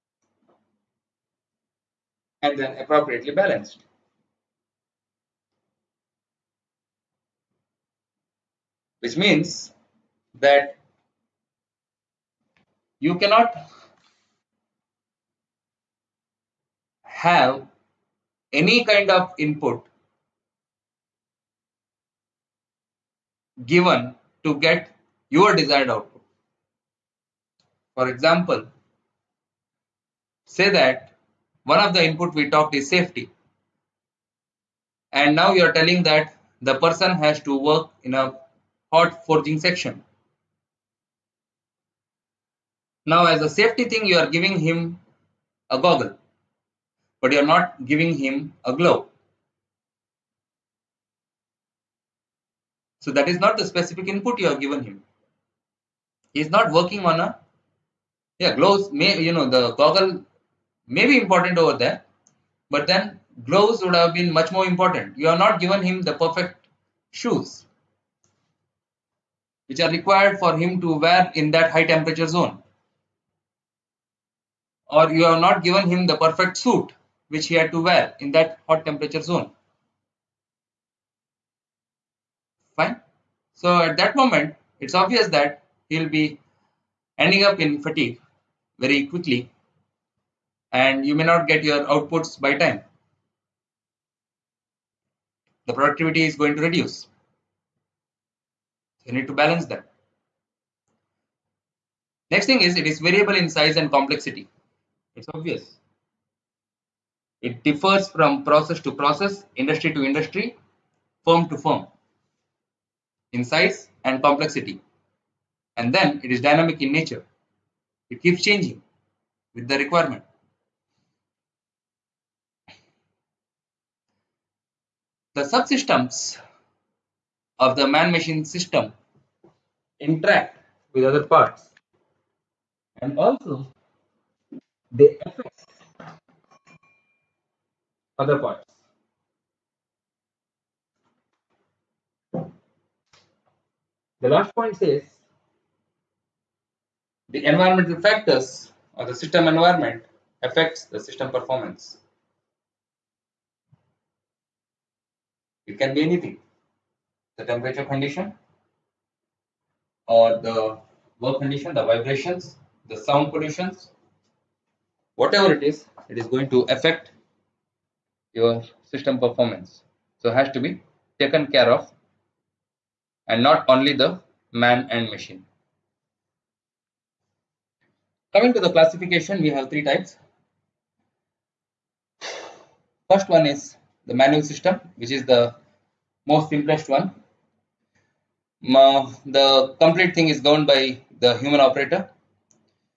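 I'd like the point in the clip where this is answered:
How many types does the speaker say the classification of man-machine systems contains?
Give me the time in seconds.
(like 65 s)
179 s.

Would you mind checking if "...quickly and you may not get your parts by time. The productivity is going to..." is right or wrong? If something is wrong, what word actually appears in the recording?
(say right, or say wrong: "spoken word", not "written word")
wrong: "outputs", not "parts".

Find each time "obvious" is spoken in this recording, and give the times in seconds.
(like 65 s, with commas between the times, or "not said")
85 s, 105 s.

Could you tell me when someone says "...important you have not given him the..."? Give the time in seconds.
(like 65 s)
64 s.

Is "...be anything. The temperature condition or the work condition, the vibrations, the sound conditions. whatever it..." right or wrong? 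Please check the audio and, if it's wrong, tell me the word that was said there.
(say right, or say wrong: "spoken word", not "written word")
right.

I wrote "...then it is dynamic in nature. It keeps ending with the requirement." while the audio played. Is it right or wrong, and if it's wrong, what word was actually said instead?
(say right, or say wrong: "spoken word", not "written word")
wrong: "changing", not "ending".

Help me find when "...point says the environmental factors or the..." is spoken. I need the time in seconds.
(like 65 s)
144 s.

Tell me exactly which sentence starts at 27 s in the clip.
For example, say that one of the input we talked is safety.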